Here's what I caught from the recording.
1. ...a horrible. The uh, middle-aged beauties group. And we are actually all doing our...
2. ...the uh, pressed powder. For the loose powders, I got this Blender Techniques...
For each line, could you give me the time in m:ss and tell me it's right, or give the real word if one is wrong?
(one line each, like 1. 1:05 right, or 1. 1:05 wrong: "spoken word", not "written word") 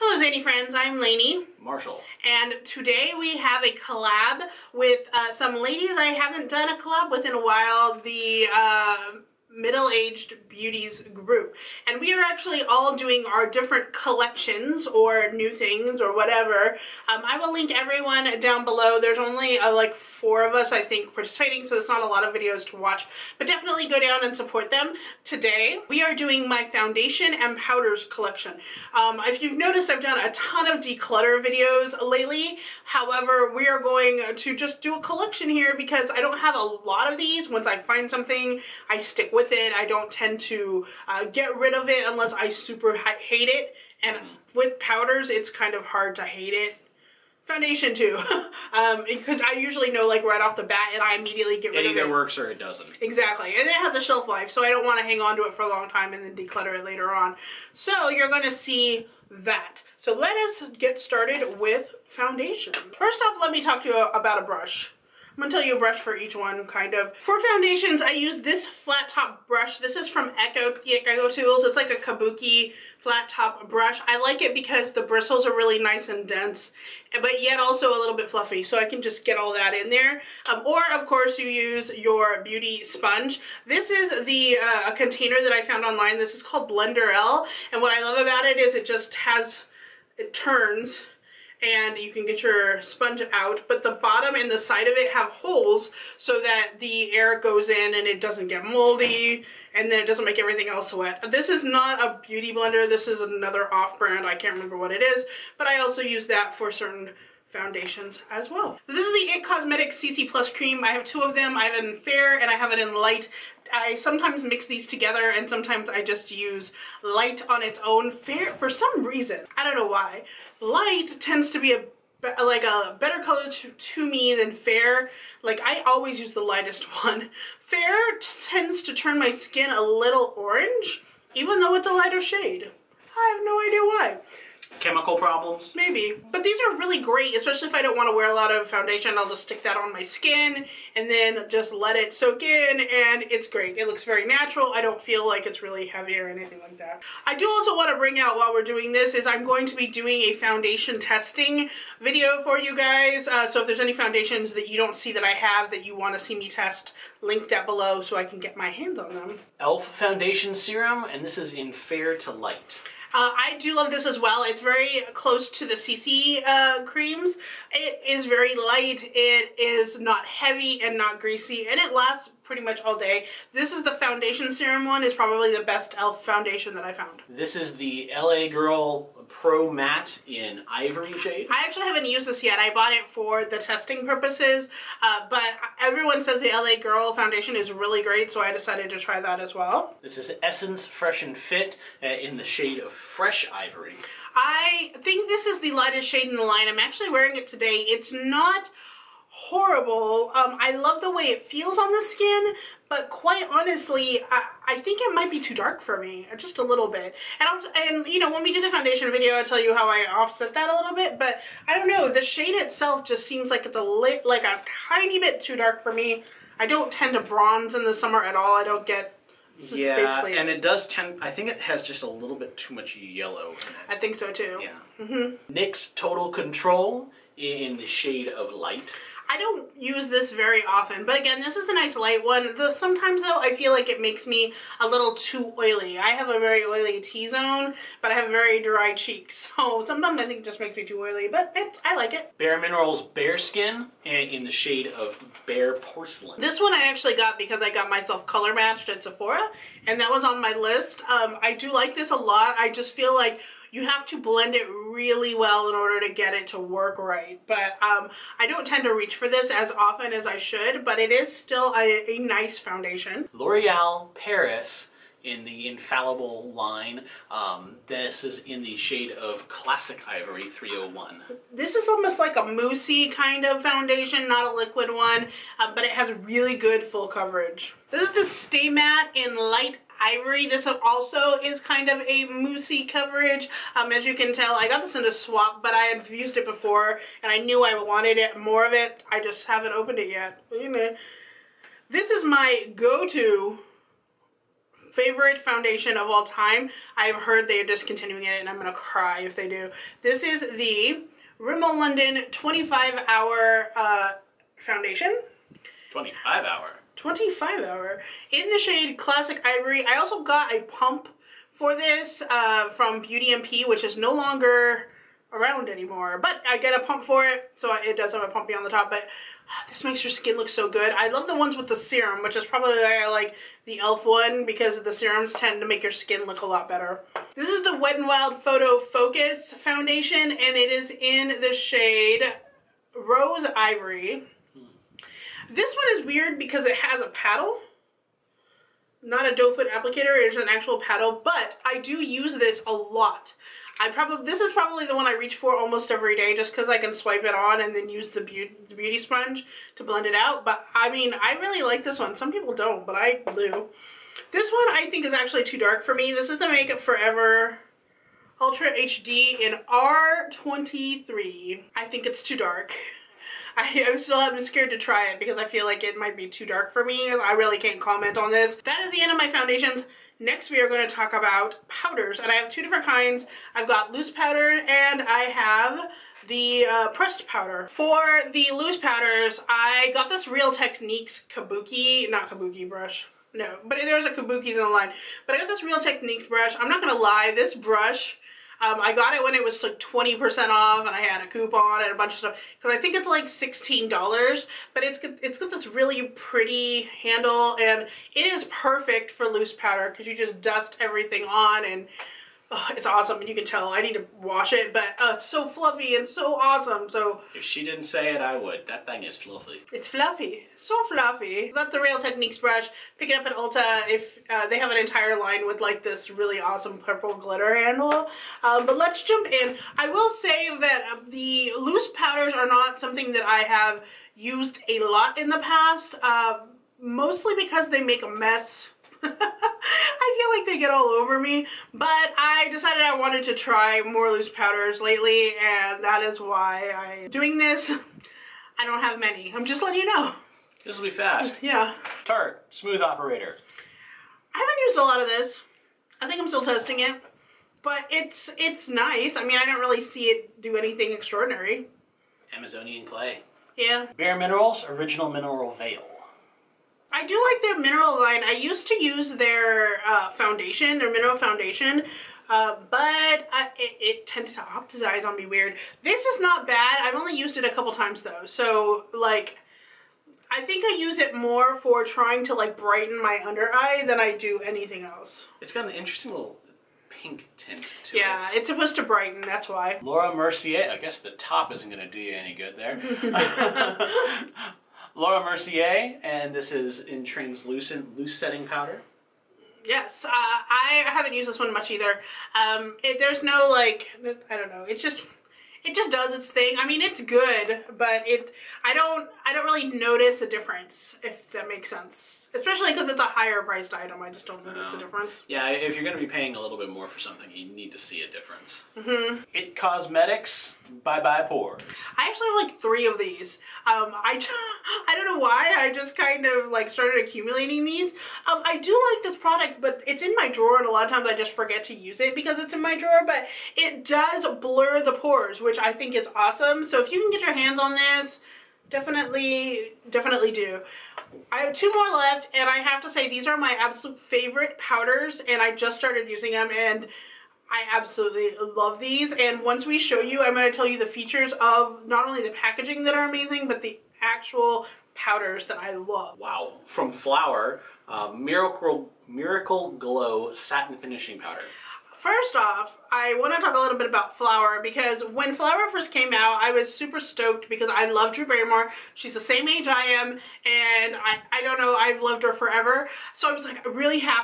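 1. 0:07 wrong: "while", not "horrible"
2. 6:16 wrong: "Real", not "Blender".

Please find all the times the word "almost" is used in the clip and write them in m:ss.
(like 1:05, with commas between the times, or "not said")
4:31, 5:45.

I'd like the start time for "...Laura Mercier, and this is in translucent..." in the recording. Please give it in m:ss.
8:04.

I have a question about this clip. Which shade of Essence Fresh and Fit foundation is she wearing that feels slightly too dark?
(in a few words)
Fresh Ivory.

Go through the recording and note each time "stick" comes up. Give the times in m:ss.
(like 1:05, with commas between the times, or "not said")
0:38, 2:19.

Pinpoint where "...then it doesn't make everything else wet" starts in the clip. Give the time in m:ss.
1:39.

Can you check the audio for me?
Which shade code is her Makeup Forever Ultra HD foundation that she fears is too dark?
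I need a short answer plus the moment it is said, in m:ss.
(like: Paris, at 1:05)
R23, at 5:59.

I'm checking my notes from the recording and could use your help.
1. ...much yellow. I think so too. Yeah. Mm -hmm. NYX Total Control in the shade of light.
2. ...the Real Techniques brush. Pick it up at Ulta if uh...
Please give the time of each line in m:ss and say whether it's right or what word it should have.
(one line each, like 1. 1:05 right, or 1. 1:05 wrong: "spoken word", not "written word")
1. 3:42 right
2. 6:51 right.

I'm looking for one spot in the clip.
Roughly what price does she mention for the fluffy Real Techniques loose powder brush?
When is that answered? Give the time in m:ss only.
6:33.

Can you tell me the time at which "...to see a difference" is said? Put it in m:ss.
8:27.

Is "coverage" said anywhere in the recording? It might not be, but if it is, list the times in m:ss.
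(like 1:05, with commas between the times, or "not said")
4:37, 4:42.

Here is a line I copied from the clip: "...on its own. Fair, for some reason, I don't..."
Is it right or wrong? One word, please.
right.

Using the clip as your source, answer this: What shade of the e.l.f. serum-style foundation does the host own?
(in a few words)
Fair to Light.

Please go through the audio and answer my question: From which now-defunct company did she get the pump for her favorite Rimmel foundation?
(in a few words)
Beauty MP.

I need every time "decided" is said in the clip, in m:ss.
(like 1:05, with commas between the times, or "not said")
3:08, 7:12.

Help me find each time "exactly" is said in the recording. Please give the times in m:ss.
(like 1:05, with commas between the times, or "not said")
0:53.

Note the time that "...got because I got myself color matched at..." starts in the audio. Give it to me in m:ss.
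4:07.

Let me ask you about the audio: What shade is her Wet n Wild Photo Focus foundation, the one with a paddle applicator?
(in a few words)
Rose Ivory.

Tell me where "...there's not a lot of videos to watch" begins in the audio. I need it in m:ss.
0:21.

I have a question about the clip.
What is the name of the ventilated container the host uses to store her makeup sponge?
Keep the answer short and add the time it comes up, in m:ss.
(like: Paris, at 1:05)
Blender L, at 1:26.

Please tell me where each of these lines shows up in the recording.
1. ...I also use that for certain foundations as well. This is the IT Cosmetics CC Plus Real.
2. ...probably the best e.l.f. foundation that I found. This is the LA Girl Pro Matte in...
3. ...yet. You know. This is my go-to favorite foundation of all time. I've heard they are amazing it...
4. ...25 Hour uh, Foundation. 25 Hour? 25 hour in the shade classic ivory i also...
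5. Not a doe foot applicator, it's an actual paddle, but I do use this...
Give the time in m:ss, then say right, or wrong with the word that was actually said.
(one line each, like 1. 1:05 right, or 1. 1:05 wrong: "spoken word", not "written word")
1. 1:45 wrong: "Cream", not "Real"
2. 2:55 right
3. 4:50 wrong: "discontinuing", not "amazing"
4. 5:02 right
5. 5:39 right.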